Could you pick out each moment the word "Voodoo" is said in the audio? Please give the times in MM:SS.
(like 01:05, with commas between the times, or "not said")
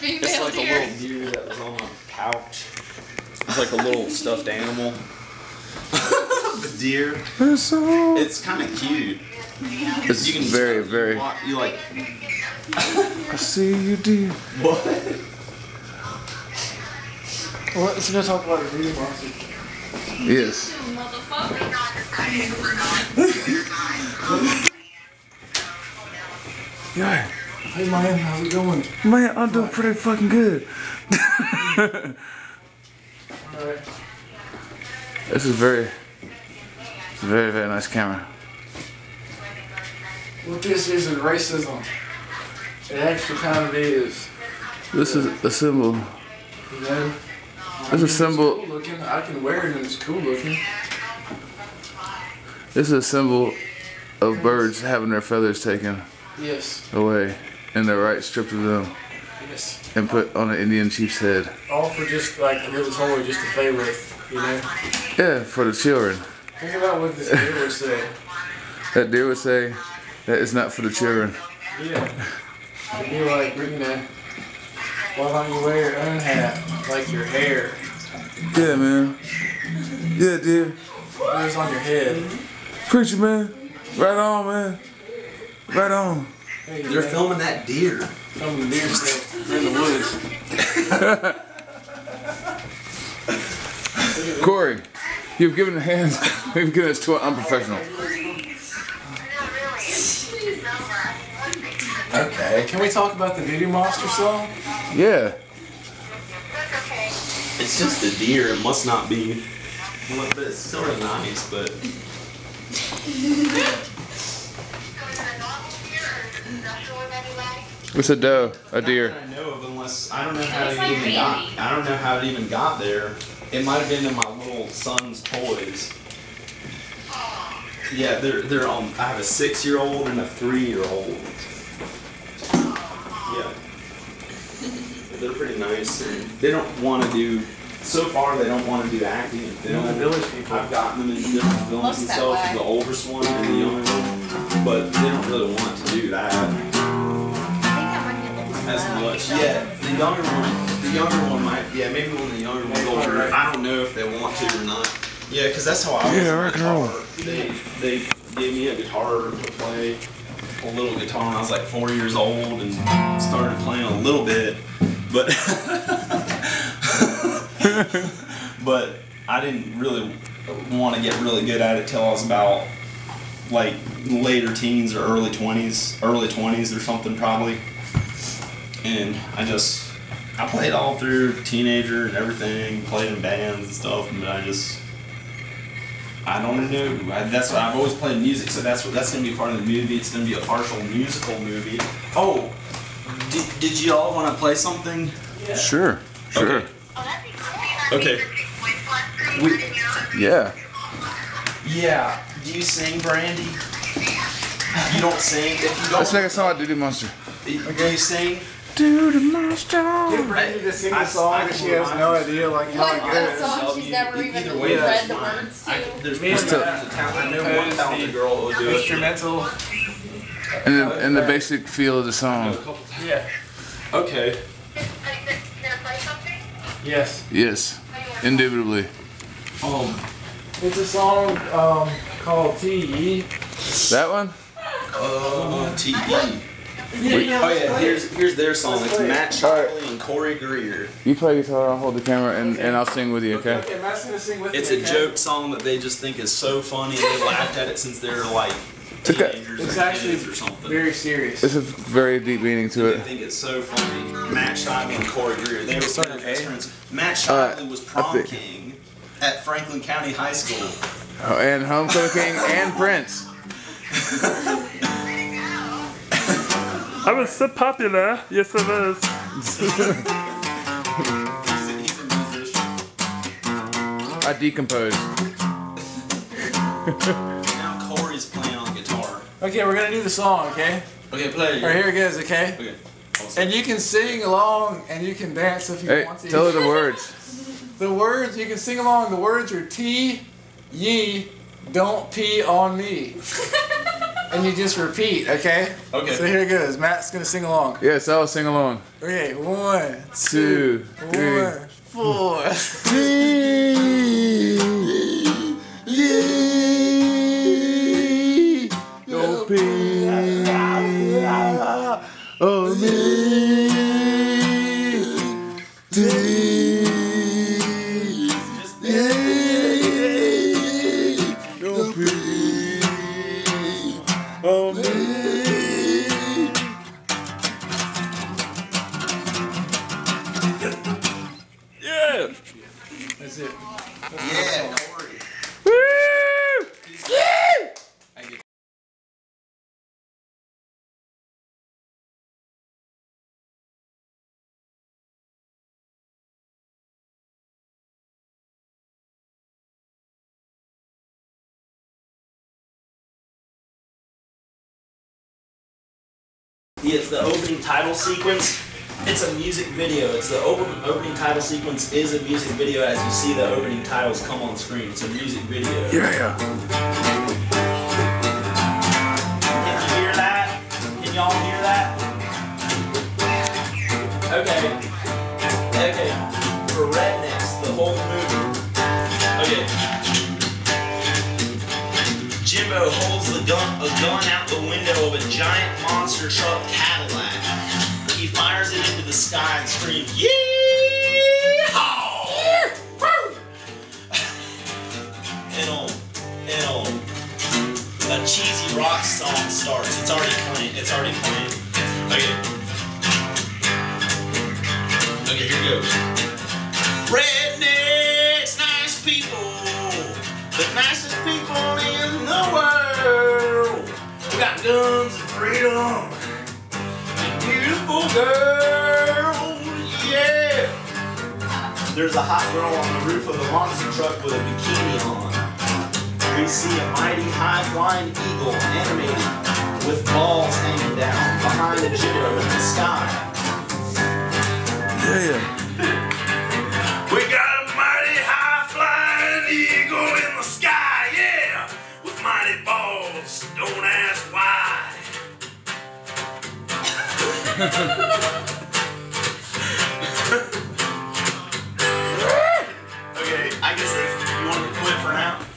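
01:43, 03:26.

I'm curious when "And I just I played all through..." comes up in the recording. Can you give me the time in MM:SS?
02:58.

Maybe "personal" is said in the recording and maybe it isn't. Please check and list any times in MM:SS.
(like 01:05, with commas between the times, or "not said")
not said.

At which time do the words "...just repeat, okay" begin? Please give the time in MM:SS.
04:54.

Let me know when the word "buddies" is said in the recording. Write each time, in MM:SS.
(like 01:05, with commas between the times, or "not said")
not said.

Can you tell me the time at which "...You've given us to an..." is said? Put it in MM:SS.
01:36.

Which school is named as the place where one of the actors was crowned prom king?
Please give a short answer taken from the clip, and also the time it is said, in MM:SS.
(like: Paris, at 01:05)
Franklin County High School, at 04:19.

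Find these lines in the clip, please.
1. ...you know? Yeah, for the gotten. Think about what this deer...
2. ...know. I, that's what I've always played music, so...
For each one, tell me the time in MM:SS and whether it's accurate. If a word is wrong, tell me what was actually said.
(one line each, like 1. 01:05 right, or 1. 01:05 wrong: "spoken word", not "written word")
1. 01:04 wrong: "children", not "gotten"
2. 03:06 right.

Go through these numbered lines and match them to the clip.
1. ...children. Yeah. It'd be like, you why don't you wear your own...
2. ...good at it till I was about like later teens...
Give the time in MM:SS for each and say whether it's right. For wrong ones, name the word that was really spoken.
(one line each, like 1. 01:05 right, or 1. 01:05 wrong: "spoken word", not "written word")
1. 01:10 right
2. 02:51 right.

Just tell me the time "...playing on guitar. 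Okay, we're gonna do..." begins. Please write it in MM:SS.
04:38.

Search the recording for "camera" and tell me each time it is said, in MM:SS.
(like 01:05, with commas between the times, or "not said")
00:37, 04:02.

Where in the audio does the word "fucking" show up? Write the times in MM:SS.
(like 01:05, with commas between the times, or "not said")
00:29.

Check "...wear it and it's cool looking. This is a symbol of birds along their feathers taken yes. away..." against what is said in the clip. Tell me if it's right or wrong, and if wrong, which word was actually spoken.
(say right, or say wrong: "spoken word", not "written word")
wrong: "having", not "along".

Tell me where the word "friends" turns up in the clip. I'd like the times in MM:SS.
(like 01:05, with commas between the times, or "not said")
04:16.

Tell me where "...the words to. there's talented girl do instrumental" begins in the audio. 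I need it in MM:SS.
03:35.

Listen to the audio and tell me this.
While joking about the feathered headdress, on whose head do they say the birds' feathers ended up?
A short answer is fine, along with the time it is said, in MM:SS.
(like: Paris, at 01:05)
an Indian chief's, at 01:00.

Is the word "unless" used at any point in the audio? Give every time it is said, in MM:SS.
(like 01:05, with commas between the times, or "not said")
01:59.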